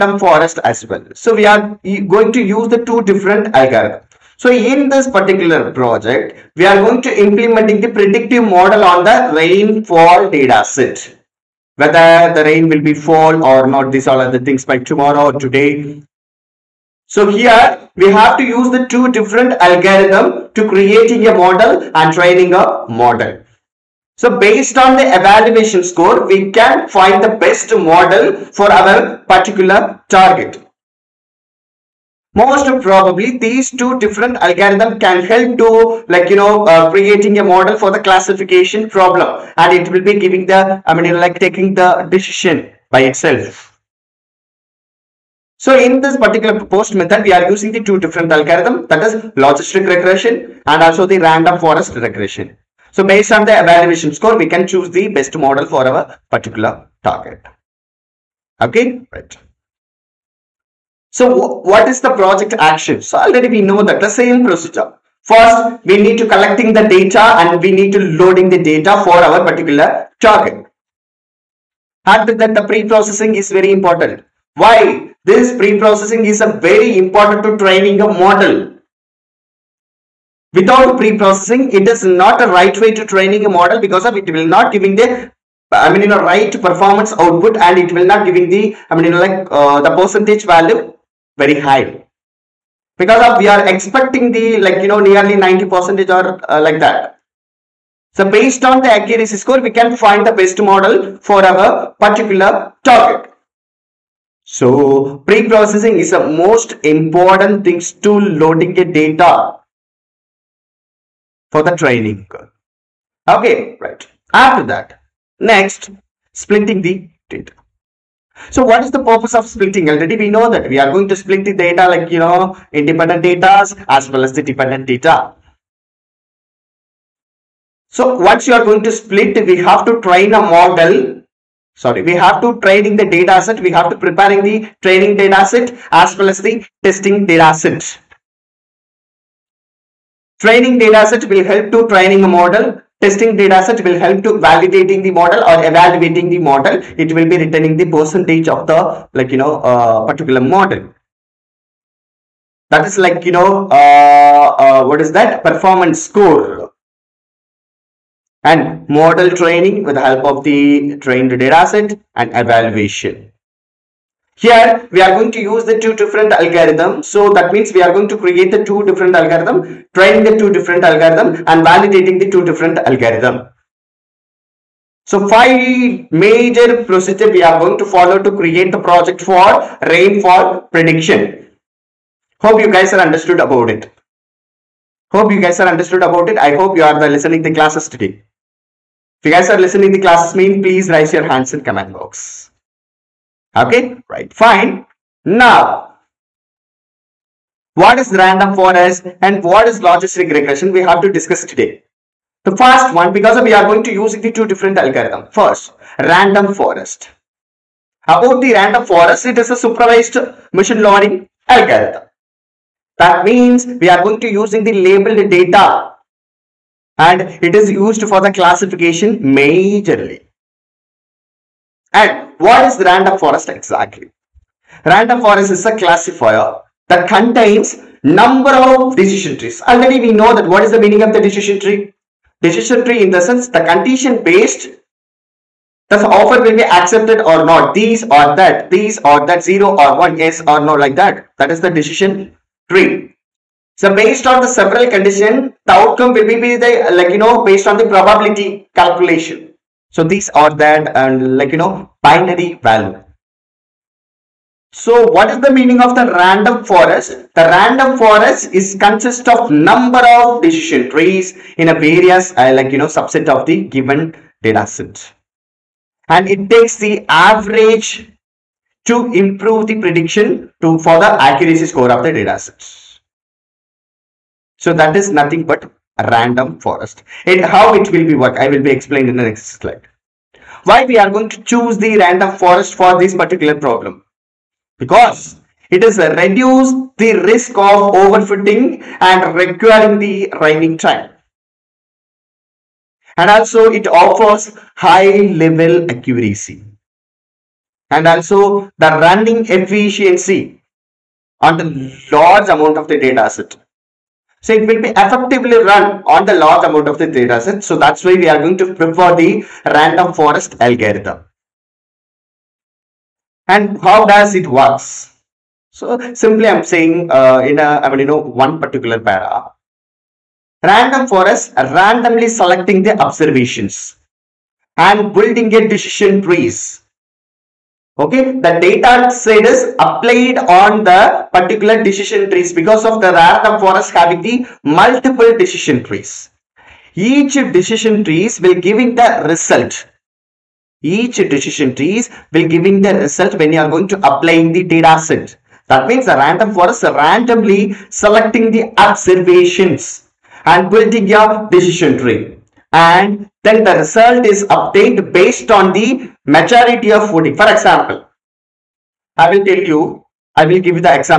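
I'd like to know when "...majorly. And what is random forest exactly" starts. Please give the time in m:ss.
3:39.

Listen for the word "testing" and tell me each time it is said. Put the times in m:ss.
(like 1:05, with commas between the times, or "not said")
2:16, 2:22.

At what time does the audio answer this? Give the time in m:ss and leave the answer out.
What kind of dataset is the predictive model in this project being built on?
0:09.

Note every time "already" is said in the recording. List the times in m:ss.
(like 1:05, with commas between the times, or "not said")
1:03, 1:59, 3:49.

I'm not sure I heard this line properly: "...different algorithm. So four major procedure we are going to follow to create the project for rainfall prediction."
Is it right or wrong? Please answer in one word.
wrong.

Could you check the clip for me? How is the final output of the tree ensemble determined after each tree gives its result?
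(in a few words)
Majority of voting.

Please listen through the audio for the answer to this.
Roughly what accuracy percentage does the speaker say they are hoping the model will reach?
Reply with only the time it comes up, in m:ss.
1:35.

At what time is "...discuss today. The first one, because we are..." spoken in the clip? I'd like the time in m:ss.
3:21.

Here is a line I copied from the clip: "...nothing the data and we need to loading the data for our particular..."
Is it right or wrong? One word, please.
wrong.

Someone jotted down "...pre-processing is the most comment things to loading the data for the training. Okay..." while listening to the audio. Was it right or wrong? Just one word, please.
wrong.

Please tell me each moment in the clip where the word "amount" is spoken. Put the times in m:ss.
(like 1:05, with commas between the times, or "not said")
5:02, 5:06.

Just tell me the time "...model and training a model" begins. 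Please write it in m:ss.
0:21.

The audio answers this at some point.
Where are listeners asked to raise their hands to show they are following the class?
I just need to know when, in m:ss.
3:11.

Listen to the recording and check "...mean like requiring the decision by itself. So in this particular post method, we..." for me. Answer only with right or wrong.
wrong.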